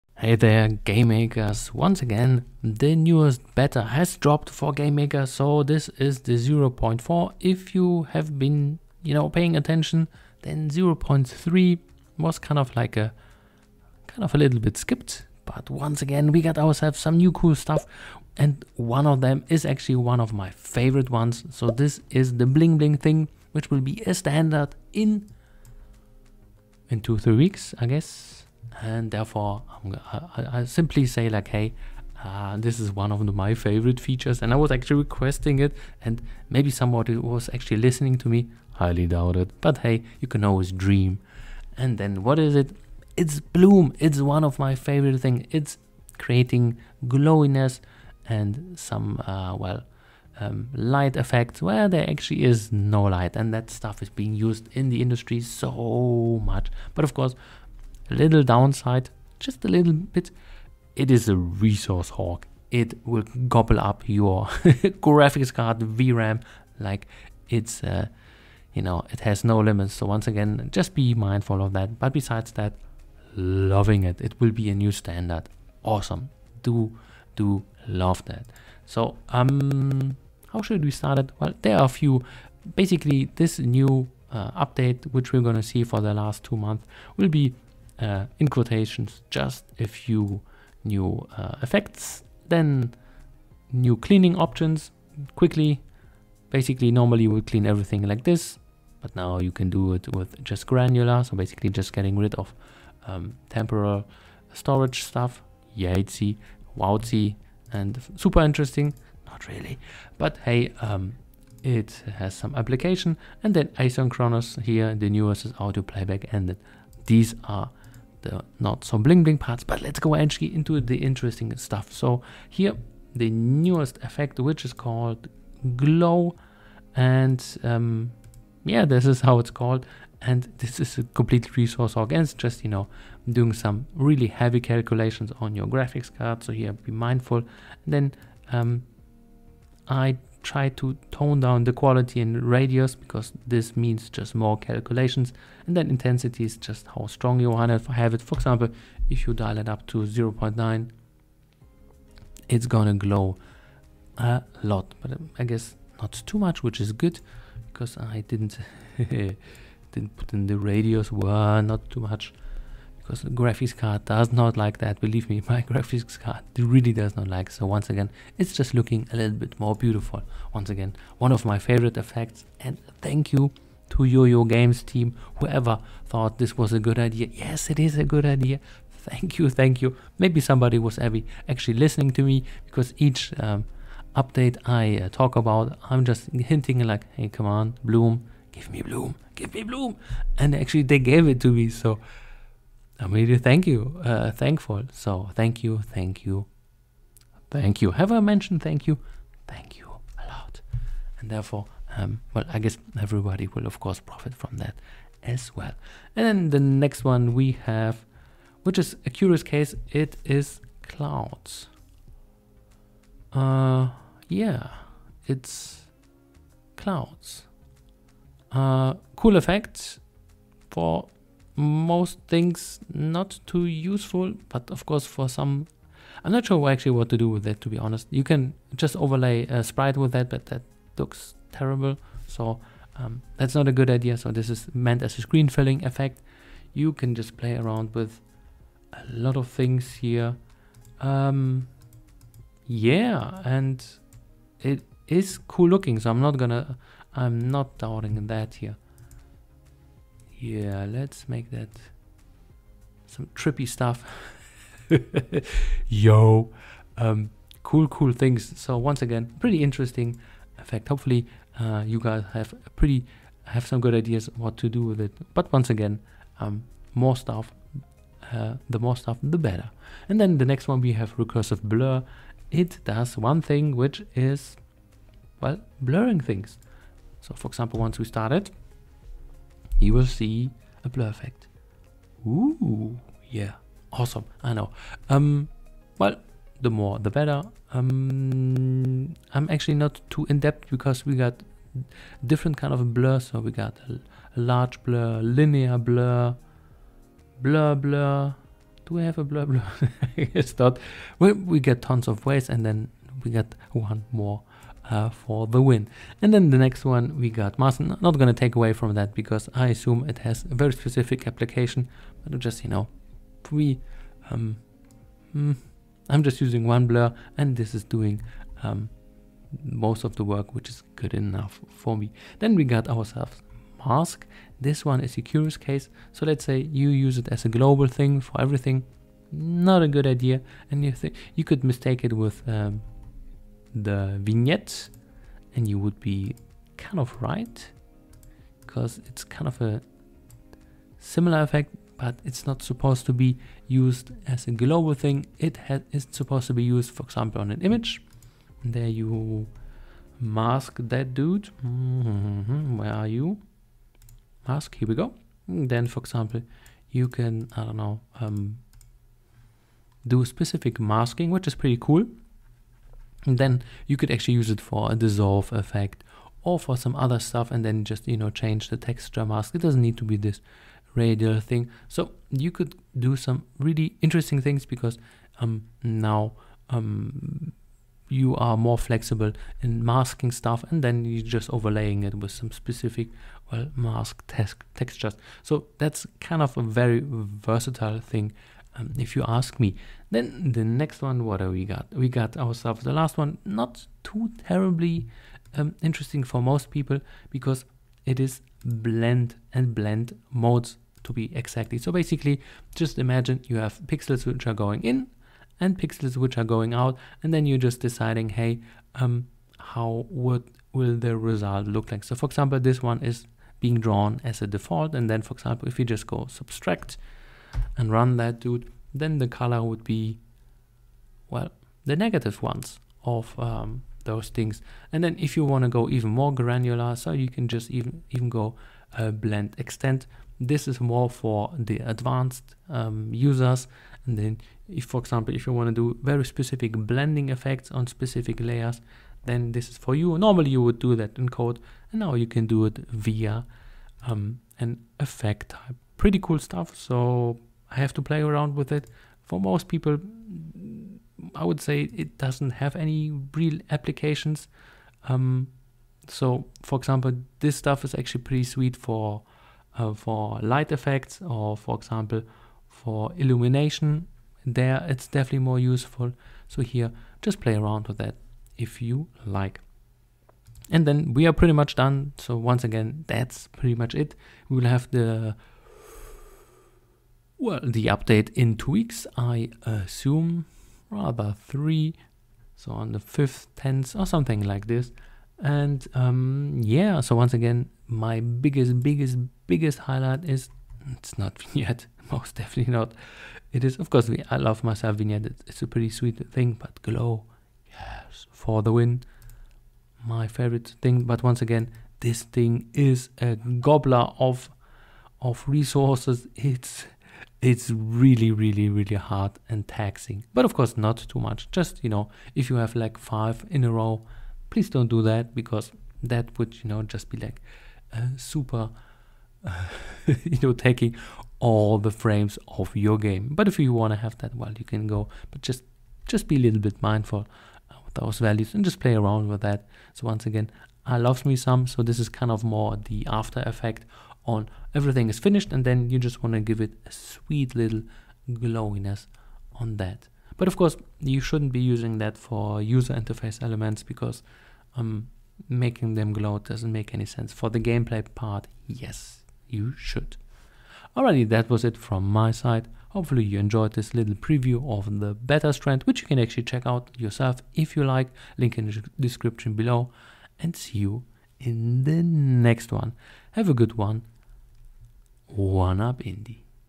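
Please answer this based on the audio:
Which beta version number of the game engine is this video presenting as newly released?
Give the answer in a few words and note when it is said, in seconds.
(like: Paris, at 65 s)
0.4, at 6 s.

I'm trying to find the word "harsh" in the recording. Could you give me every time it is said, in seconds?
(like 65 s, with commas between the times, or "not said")
not said.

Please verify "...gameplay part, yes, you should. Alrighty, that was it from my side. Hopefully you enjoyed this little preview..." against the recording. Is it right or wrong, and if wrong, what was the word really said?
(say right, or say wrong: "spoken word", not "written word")
right.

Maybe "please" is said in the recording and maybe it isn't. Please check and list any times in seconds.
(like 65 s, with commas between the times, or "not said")
514 s.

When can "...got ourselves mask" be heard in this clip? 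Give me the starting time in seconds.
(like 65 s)
322 s.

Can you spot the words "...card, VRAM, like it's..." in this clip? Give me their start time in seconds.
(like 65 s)
65 s.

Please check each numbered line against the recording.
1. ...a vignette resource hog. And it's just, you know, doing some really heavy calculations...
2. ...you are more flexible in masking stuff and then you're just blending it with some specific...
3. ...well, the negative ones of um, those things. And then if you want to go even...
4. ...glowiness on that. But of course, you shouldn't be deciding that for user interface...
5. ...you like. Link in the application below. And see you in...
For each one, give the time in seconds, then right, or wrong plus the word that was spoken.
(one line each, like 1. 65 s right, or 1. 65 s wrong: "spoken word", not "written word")
1. 130 s wrong: "complete", not "vignette"
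2. 378 s wrong: "overlaying", not "blending"
3. 421 s right
4. 538 s wrong: "using", not "deciding"
5. 557 s wrong: "description", not "application".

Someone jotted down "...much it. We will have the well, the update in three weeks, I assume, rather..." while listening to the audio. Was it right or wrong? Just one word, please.
wrong.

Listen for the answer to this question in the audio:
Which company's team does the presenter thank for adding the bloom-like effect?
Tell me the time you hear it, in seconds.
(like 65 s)
173 s.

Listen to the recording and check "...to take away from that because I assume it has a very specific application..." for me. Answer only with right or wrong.
right.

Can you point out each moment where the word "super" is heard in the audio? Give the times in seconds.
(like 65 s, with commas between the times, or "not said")
108 s, 518 s.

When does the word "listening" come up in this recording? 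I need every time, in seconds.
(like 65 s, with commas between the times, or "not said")
37 s, 181 s.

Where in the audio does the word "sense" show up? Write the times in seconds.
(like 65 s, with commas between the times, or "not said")
547 s.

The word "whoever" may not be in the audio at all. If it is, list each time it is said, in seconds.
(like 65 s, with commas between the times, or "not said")
175 s.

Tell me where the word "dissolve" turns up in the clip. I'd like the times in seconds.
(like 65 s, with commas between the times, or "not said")
364 s.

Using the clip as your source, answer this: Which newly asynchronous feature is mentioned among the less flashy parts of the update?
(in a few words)
Audio playback.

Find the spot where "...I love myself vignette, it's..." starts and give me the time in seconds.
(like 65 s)
494 s.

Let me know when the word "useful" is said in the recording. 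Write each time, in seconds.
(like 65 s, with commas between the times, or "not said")
223 s, 465 s.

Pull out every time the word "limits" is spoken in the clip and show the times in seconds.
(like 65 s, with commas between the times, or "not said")
69 s.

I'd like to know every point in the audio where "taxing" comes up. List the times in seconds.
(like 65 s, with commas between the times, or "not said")
509 s.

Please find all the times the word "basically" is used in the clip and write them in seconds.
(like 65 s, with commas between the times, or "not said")
82 s, 96 s, 101 s, 401 s.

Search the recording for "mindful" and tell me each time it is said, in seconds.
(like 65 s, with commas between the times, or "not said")
71 s, 136 s, 526 s.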